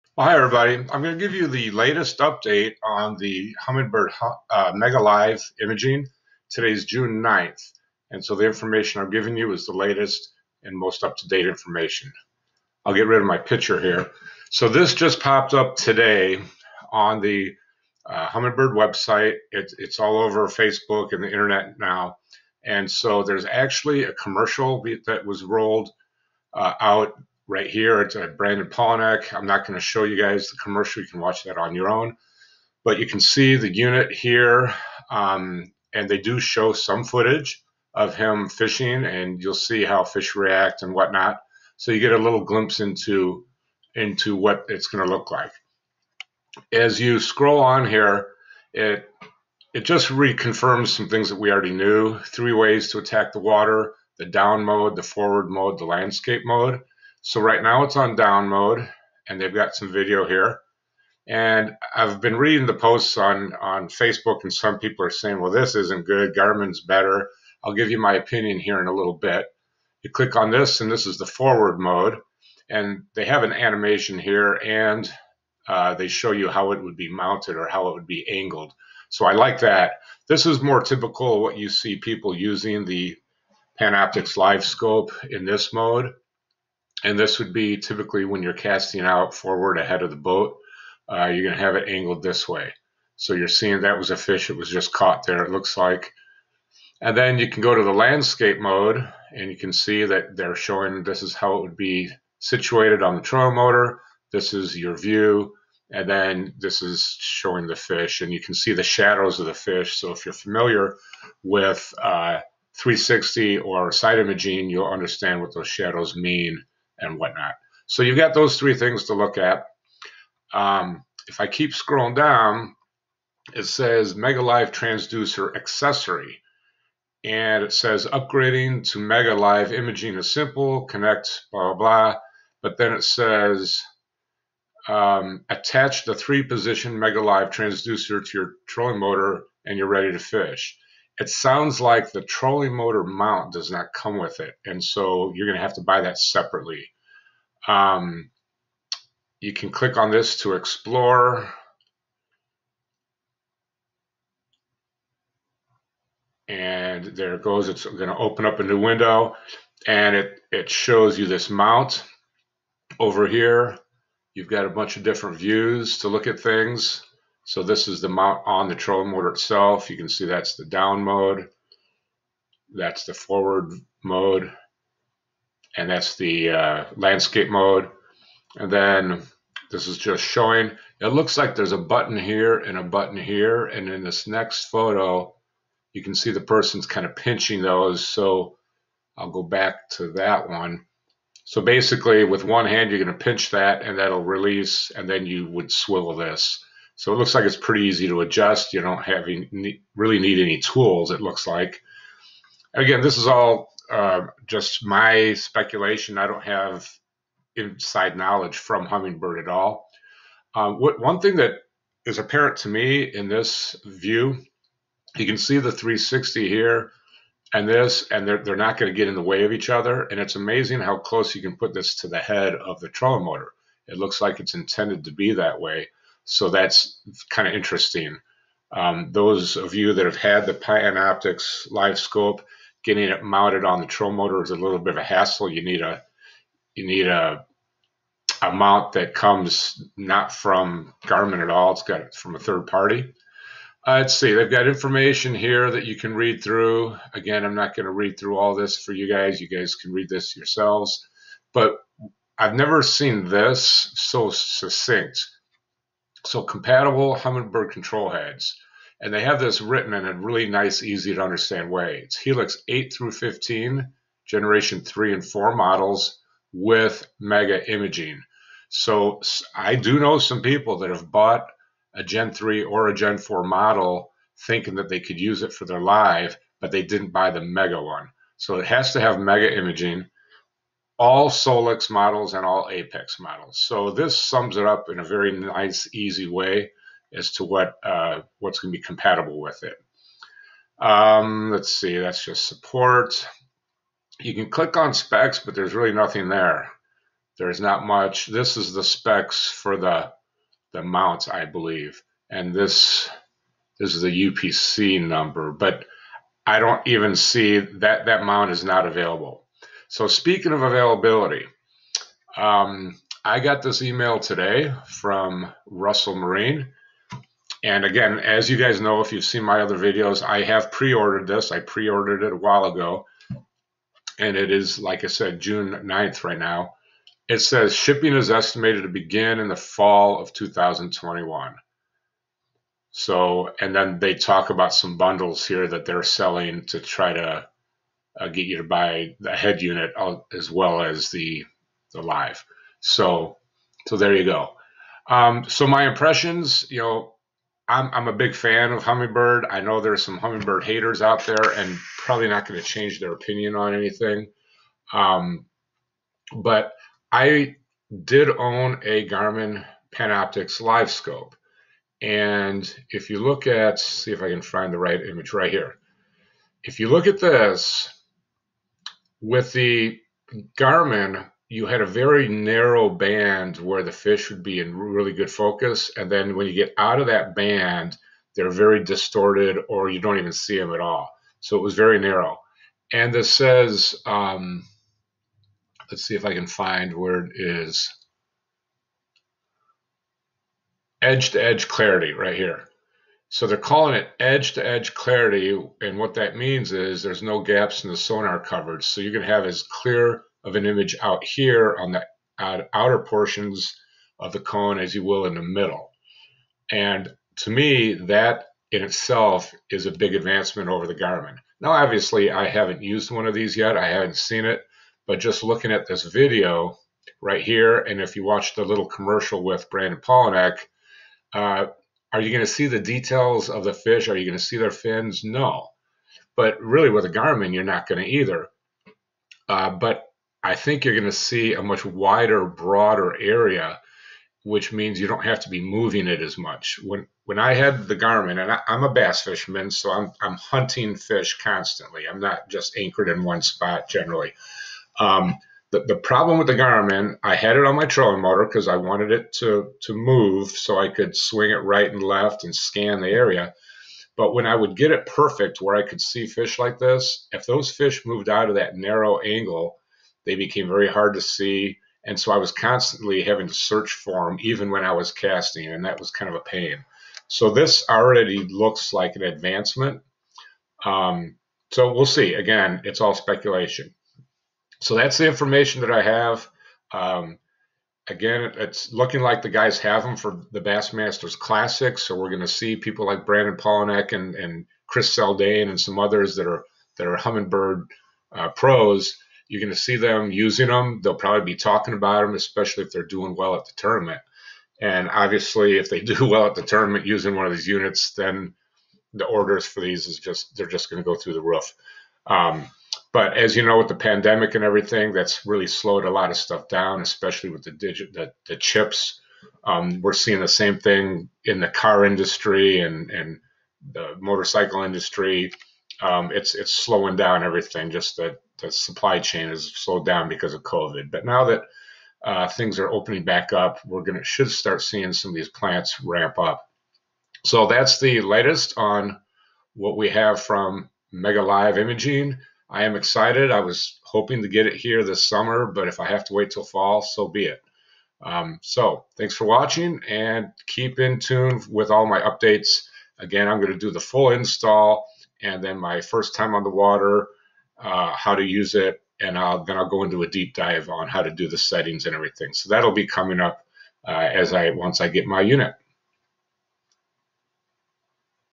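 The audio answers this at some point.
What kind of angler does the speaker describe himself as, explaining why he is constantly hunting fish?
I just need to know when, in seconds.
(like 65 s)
438 s.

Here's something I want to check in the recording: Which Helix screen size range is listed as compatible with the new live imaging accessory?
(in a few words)
8 through 15.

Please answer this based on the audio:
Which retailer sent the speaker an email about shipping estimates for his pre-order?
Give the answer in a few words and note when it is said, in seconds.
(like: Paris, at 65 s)
Russell Marine, at 315 s.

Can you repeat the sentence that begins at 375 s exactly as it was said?
And then when you get out of that band, they're very distorted or you don't even see them at all.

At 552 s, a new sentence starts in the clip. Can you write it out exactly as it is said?
So that'll be coming up uh, as I once I get my unit.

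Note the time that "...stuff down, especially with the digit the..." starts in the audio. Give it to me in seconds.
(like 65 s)
506 s.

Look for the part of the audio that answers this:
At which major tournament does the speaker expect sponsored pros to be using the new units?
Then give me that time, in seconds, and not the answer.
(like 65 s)
480 s.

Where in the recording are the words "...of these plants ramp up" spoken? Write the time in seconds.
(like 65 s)
525 s.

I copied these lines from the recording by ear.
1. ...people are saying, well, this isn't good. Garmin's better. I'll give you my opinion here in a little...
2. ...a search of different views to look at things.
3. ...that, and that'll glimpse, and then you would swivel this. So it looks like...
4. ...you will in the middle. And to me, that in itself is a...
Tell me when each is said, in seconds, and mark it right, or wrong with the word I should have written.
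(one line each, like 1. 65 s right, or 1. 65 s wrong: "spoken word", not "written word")
1. 64 s right
2. 164 s wrong: "bunch", not "search"
3. 193 s wrong: "release", not "glimpse"
4. 404 s right.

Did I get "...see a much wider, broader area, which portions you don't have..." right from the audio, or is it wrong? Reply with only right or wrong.
wrong.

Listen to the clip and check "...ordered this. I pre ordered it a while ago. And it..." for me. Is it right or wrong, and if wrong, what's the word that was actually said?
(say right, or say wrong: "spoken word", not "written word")
right.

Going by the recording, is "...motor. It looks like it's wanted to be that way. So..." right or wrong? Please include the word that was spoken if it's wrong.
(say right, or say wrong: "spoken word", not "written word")
wrong: "intended", not "wanted".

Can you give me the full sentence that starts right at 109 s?
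So if you're familiar with uh, 360 or side imaging, you'll understand what those shadows mean and whatnot.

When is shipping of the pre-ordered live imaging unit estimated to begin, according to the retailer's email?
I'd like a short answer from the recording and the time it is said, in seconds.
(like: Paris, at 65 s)
fall of 2021, at 329 s.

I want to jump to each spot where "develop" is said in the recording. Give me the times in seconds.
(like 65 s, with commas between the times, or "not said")
not said.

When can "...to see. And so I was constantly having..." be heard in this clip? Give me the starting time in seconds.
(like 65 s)
461 s.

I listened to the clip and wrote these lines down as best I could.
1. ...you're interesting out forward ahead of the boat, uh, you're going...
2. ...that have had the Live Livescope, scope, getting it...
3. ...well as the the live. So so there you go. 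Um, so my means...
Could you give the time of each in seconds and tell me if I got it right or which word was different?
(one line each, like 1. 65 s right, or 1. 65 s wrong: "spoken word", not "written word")
1. 88 s wrong: "casting", not "interesting"
2. 229 s wrong: "Panoptix", not "Live"
3. 340 s wrong: "impressions", not "means".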